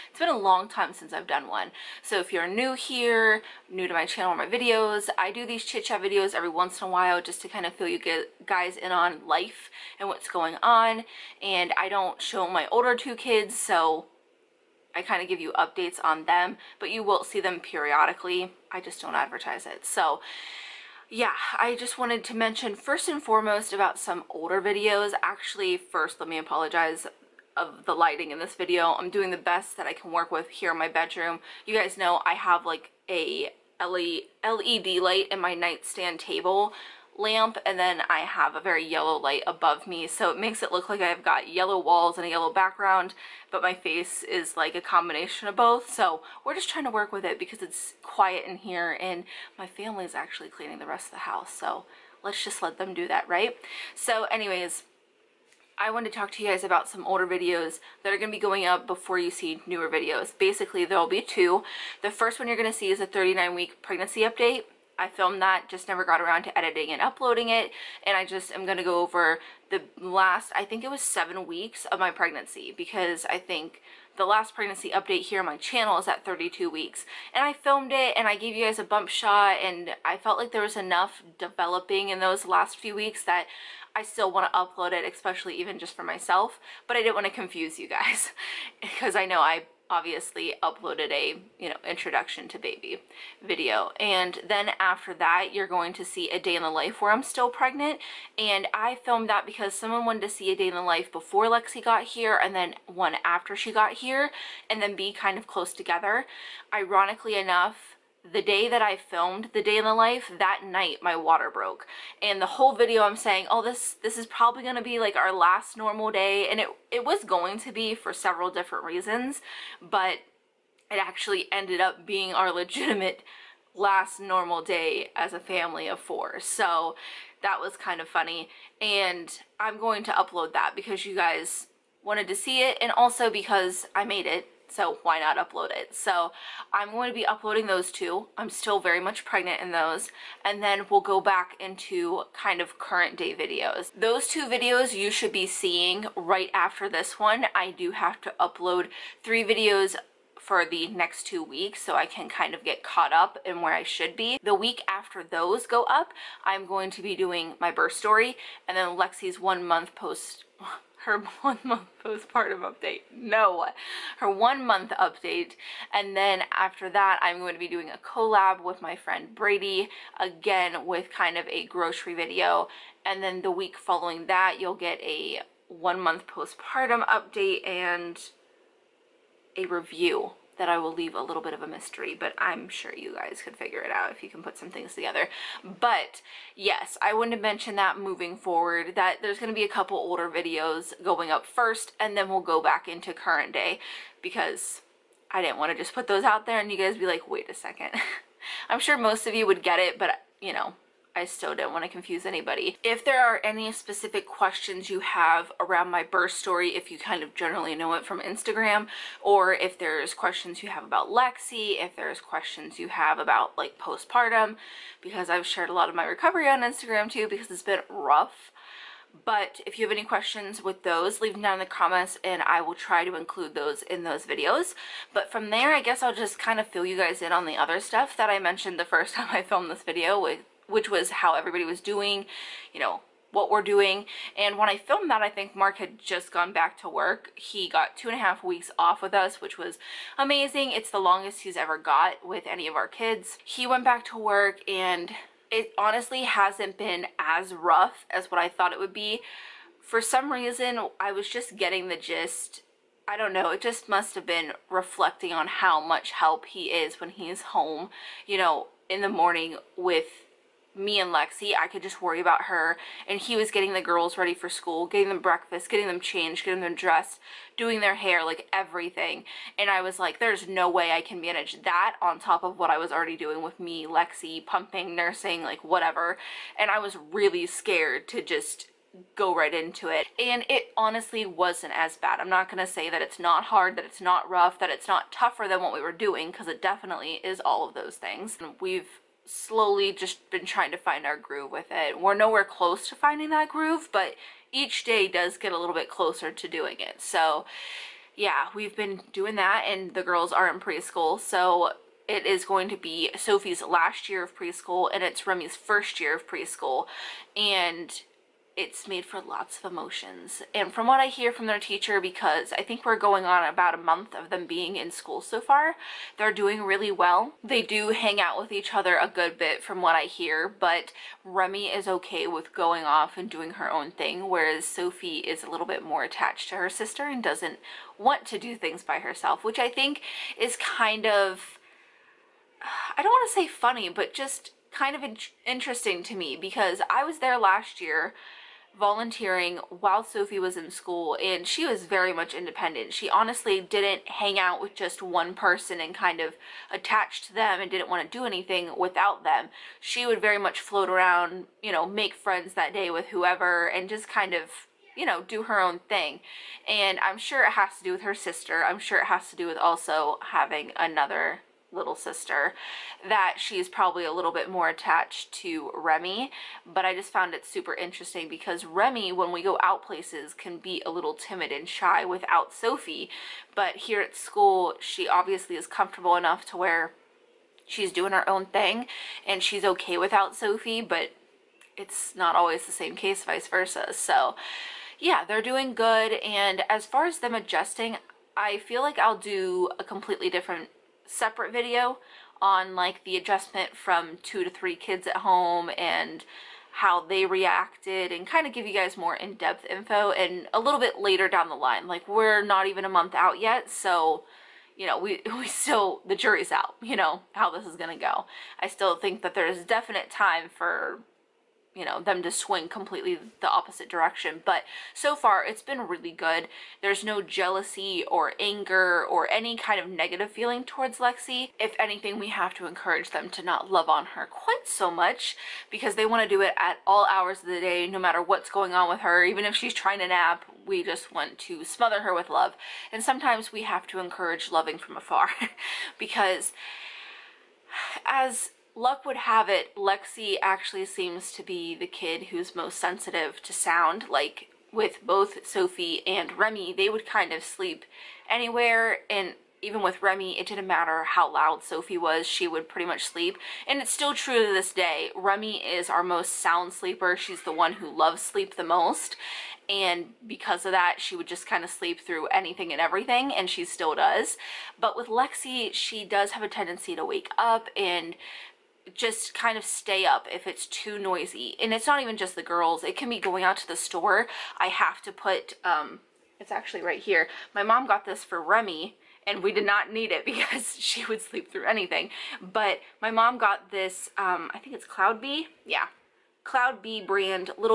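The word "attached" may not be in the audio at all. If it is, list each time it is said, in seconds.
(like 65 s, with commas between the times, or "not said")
326 s, 346 s, 364 s.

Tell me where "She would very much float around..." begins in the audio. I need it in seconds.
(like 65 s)
349 s.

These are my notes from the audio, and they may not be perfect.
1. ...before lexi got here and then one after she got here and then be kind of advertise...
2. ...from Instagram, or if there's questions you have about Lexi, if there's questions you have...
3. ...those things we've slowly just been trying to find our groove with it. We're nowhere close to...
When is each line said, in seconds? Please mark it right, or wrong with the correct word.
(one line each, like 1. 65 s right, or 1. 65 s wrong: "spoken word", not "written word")
1. 101 s wrong: "close", not "advertise"
2. 208 s right
3. 287 s right.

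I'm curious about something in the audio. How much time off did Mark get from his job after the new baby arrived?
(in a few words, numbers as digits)
two and a half weeks.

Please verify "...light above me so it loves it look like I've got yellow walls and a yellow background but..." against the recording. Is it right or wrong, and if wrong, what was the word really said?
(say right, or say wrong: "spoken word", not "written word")
wrong: "makes", not "loves".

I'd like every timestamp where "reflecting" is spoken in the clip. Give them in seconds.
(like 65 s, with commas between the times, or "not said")
254 s.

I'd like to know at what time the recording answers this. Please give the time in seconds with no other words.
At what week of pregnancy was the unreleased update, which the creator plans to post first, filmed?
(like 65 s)
63 s.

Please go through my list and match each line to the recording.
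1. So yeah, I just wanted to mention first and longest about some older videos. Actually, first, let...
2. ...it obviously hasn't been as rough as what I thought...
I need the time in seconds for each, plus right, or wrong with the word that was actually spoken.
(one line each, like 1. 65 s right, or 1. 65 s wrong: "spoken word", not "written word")
1. 19 s wrong: "foremost", not "longest"
2. 245 s wrong: "honestly", not "obviously".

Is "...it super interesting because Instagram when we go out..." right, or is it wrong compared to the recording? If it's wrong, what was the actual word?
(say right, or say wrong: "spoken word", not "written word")
wrong: "Remy", not "Instagram".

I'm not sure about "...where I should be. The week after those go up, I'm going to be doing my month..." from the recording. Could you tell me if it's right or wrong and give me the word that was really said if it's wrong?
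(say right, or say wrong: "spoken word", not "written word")
wrong: "birth", not "month".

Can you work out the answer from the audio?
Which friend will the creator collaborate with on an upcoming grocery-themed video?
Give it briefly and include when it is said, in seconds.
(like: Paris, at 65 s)
Brady, at 169 s.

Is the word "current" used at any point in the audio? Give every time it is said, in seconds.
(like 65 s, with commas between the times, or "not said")
142 s, 193 s.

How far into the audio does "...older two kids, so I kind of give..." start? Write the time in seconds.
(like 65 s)
12 s.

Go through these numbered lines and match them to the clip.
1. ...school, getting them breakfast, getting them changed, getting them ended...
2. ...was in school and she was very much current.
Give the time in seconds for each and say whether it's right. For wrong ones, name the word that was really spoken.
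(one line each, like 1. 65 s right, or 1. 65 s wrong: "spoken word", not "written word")
1. 264 s wrong: "dressed", not "ended"
2. 340 s wrong: "independent", not "current".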